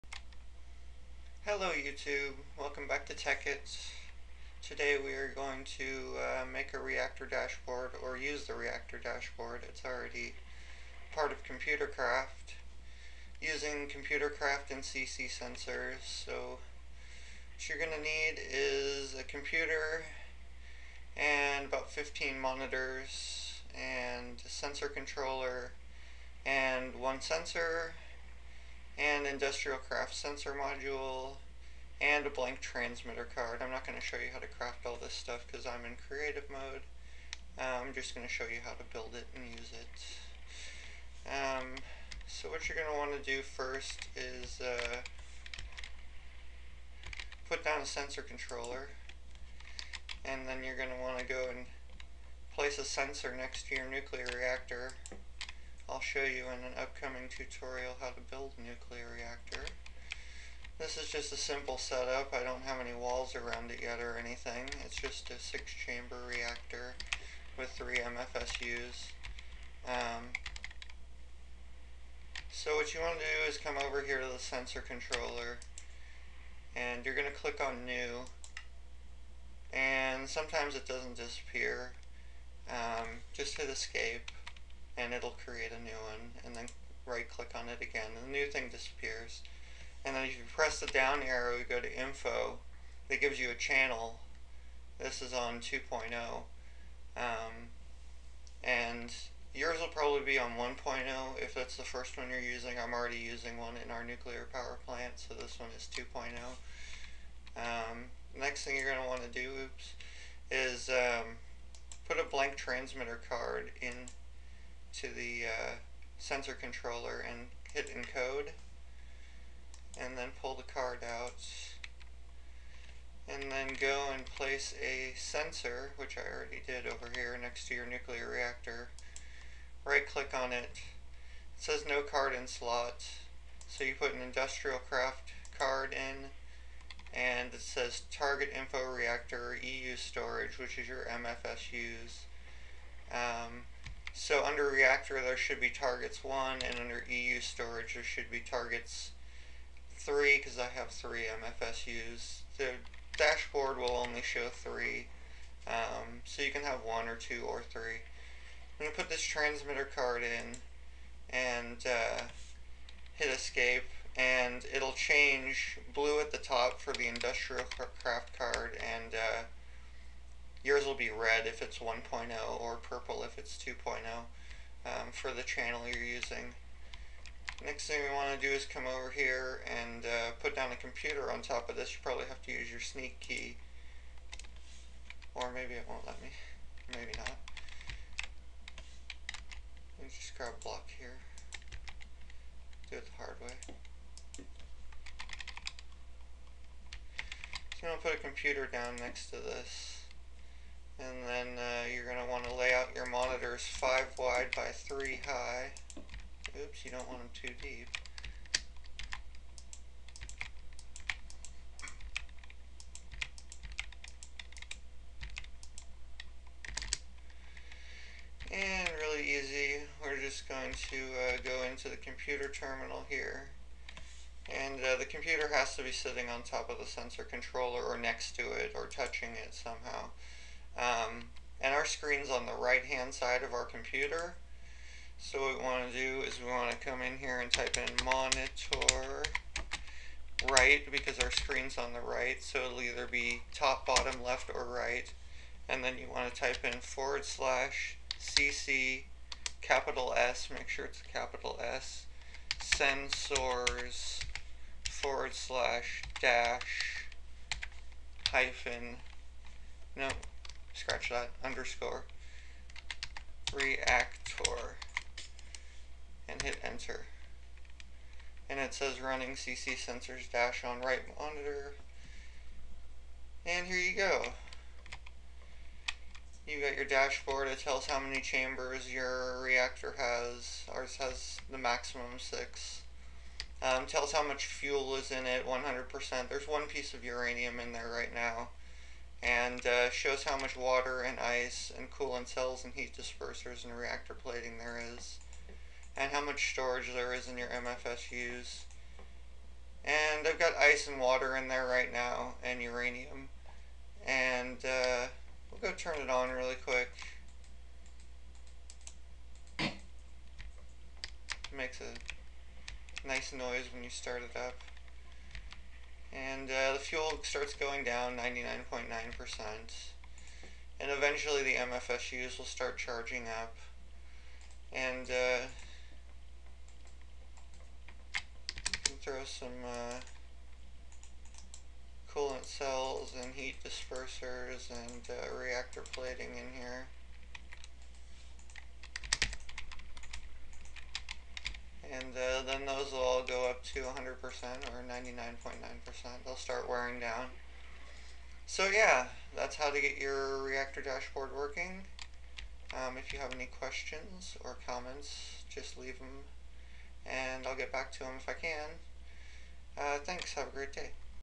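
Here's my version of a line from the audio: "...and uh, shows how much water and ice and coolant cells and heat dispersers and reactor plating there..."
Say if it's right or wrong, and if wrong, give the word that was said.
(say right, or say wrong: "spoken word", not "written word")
right.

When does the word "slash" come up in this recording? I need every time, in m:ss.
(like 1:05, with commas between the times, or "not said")
4:07, 4:15.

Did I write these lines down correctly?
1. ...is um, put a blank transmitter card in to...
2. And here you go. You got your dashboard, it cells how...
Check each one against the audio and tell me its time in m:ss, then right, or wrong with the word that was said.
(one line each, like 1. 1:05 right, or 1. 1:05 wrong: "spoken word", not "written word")
1. 1:50 right
2. 4:33 wrong: "tells", not "cells".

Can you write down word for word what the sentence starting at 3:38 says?
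And really easy, we're just going to uh, go into the computer terminal here.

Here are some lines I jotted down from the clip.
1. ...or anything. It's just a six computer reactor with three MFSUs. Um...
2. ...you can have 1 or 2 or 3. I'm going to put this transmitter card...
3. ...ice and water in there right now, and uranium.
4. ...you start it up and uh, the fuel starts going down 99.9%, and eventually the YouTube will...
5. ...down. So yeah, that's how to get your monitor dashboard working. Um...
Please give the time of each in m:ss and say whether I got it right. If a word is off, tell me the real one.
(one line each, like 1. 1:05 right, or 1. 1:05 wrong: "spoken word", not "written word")
1. 1:03 wrong: "chamber", not "computer"
2. 2:36 right
3. 5:00 right
4. 5:13 wrong: "MFSUs", not "YouTube"
5. 5:46 wrong: "reactor", not "monitor".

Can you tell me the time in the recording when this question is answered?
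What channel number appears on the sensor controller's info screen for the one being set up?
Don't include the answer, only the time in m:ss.
1:34.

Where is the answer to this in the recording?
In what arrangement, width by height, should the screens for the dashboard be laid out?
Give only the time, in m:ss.
3:23.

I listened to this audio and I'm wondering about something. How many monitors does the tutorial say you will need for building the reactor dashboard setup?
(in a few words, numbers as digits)
15.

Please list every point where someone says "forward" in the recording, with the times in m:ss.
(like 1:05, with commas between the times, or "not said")
4:06, 4:14.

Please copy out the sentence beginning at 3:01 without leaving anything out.
You probably have to use your sneak key.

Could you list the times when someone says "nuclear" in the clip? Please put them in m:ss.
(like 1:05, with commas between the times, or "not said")
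0:53, 0:58, 1:44, 2:07.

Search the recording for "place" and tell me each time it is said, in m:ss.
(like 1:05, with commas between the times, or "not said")
0:52, 2:04.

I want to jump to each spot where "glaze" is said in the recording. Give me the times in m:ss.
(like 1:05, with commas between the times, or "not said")
not said.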